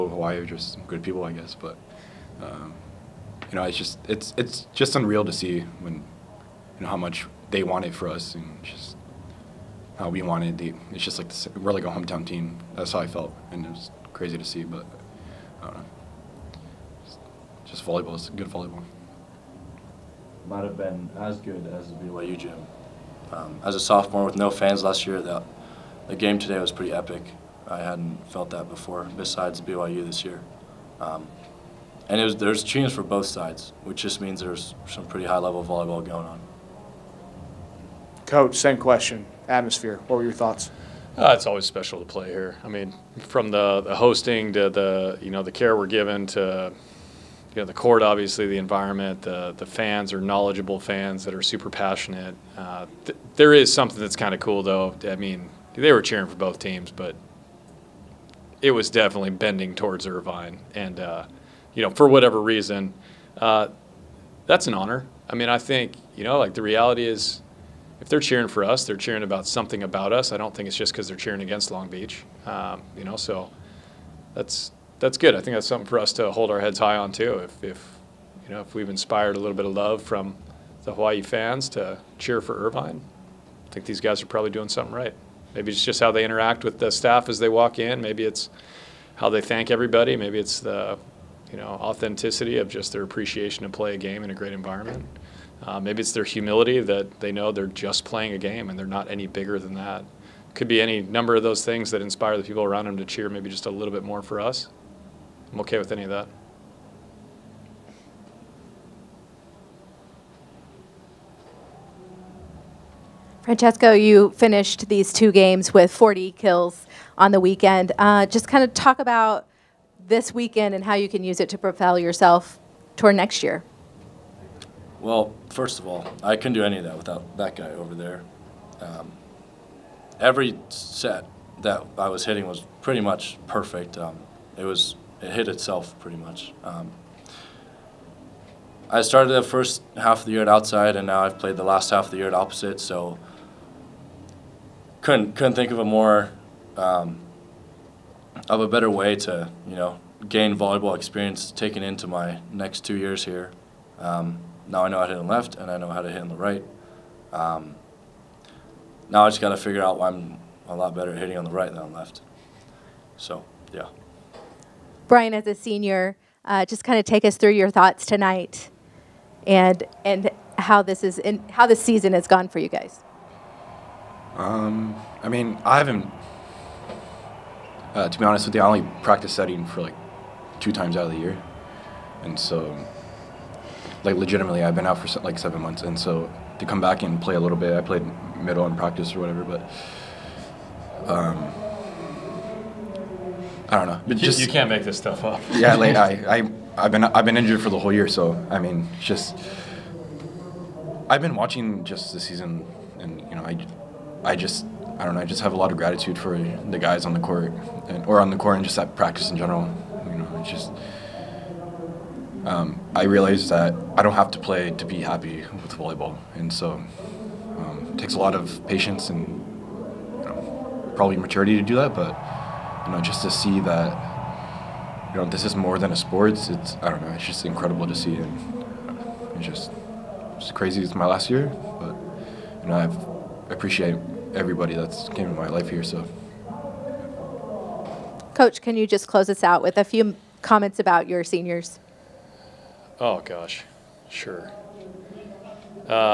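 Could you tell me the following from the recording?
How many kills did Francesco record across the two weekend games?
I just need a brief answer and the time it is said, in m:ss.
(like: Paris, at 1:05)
40, at 1:55.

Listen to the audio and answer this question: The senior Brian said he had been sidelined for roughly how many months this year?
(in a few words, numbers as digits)
7 months.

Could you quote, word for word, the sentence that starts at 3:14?
You, just, you can't make this stuff up.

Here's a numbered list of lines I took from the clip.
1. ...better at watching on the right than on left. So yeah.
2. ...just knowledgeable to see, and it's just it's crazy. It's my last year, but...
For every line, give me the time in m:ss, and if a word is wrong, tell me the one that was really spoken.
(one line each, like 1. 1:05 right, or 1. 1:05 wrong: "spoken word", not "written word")
1. 2:40 wrong: "hitting", not "watching"
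2. 3:47 wrong: "incredible", not "knowledgeable".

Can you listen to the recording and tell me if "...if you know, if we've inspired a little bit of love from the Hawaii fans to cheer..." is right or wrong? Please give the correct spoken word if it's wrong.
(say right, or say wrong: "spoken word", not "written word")
right.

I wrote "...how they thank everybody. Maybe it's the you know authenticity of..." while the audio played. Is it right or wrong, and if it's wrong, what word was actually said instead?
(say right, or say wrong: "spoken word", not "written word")
right.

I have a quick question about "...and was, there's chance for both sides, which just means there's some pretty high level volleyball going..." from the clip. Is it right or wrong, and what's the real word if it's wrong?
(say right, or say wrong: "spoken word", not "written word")
right.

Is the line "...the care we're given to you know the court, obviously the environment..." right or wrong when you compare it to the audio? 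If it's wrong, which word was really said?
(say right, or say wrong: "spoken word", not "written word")
right.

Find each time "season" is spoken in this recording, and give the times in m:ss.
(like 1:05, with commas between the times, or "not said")
2:51, 3:22.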